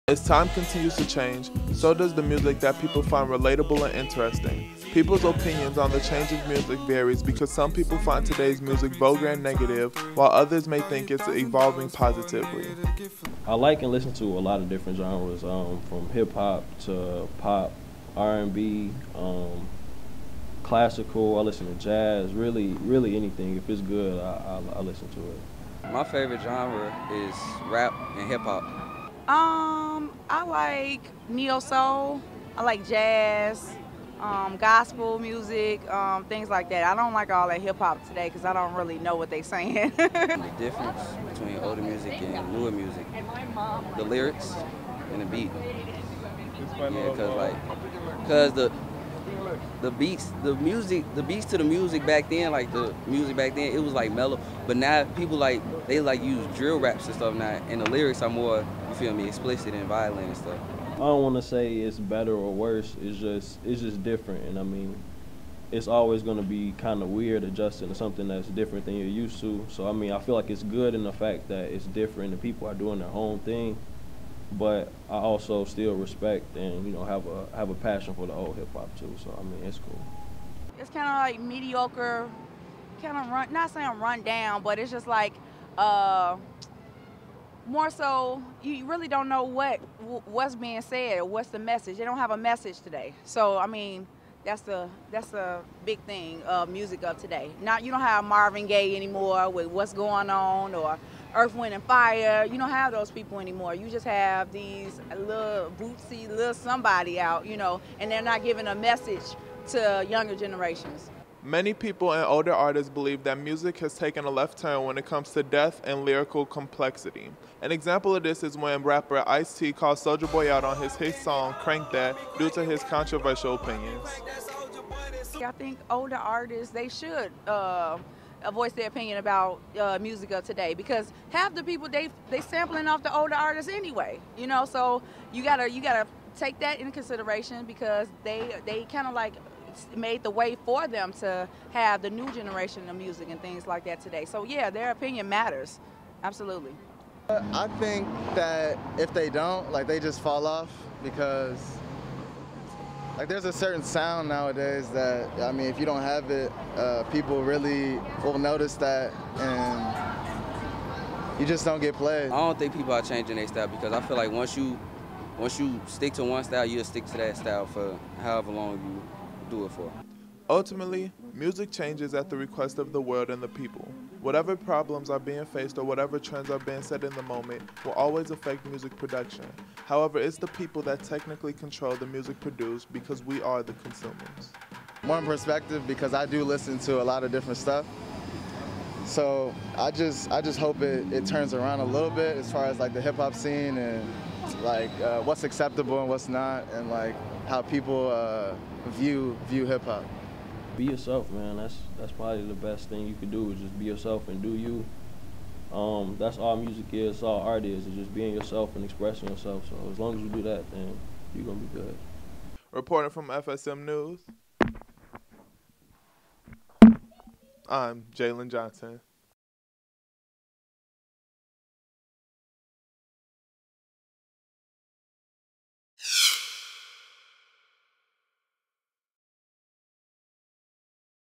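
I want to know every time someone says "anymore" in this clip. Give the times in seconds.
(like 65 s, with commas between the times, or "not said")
98 s, 103 s.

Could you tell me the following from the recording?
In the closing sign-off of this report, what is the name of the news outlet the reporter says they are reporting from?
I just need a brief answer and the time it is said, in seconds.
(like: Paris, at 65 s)
FSM News, at 213 s.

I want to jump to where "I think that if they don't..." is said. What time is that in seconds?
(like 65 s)
147 s.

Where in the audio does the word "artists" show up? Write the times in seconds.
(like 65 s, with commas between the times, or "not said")
112 s, 126 s, 133 s.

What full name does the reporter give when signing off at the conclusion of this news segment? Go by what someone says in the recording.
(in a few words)
Jalen Johnson.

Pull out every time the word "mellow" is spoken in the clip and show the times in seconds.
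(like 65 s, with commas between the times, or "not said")
54 s.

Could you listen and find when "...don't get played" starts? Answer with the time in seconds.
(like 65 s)
161 s.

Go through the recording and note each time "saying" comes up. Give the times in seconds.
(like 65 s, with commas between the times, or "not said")
39 s, 83 s.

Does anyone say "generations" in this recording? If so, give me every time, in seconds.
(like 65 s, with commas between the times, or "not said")
110 s, 142 s.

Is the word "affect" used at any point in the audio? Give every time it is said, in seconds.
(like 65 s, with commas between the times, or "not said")
178 s.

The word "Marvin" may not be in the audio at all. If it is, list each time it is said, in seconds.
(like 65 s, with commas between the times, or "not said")
98 s.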